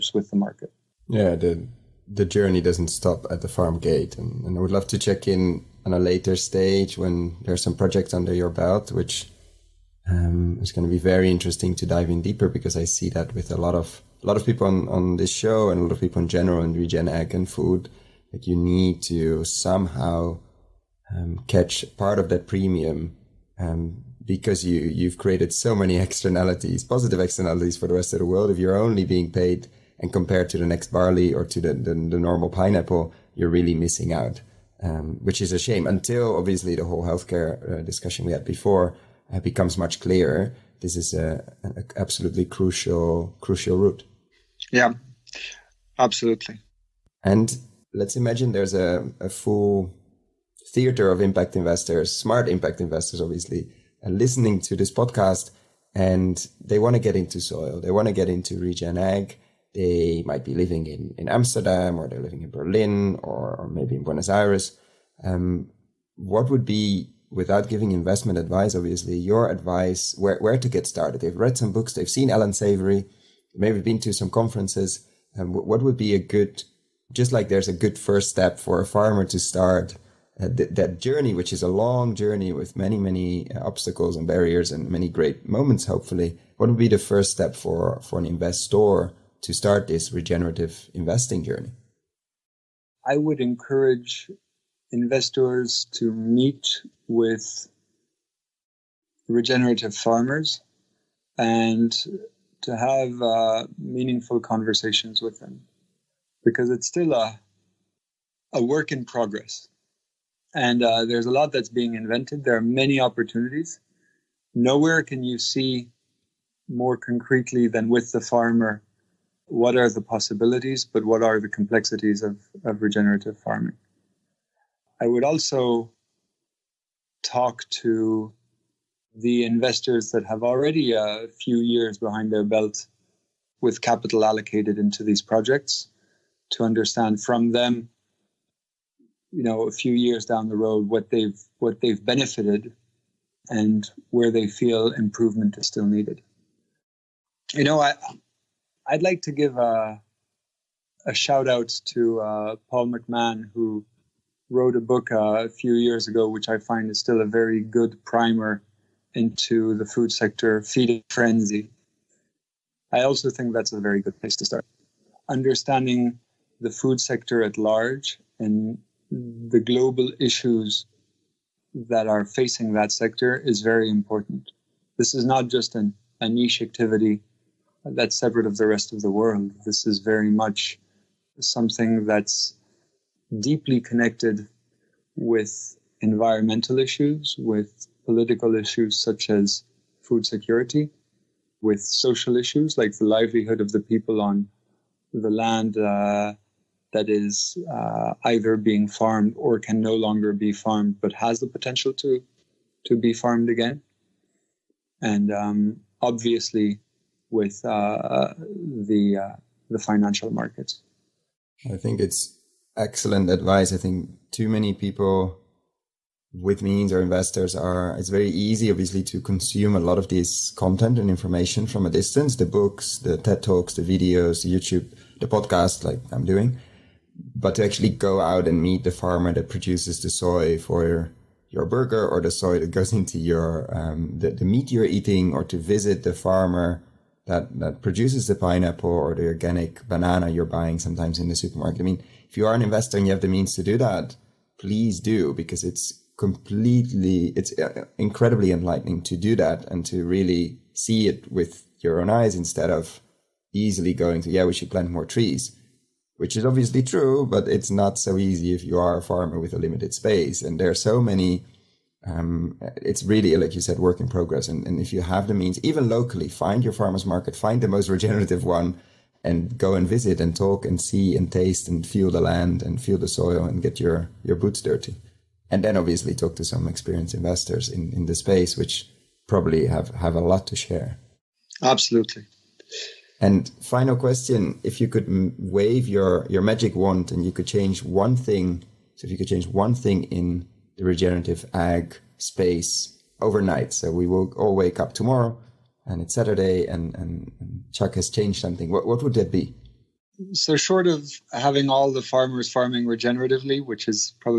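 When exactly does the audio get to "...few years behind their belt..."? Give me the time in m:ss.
2:11.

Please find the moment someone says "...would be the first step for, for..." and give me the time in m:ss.
1:26.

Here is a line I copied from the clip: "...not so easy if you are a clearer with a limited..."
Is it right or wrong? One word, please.
wrong.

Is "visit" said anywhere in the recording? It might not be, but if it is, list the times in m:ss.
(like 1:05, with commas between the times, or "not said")
3:55, 4:29.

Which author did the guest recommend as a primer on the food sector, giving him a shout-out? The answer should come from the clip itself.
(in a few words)
Paul McMahon.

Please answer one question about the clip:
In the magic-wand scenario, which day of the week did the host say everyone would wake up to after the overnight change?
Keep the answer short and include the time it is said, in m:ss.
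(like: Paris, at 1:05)
Saturday, at 4:56.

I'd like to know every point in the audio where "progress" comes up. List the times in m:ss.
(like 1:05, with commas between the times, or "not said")
1:49, 4:24.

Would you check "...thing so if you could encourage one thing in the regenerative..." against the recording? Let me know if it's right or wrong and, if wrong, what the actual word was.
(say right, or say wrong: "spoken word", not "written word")
wrong: "change", not "encourage".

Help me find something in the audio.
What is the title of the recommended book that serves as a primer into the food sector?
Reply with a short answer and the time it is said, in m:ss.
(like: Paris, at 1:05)
Feeding Frenzy, at 2:40.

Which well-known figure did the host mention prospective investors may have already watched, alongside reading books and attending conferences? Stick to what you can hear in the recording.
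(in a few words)
Allan Savory.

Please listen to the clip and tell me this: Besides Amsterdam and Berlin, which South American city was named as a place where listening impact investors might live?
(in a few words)
Buenos Aires.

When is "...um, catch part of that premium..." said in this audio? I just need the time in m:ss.
0:21.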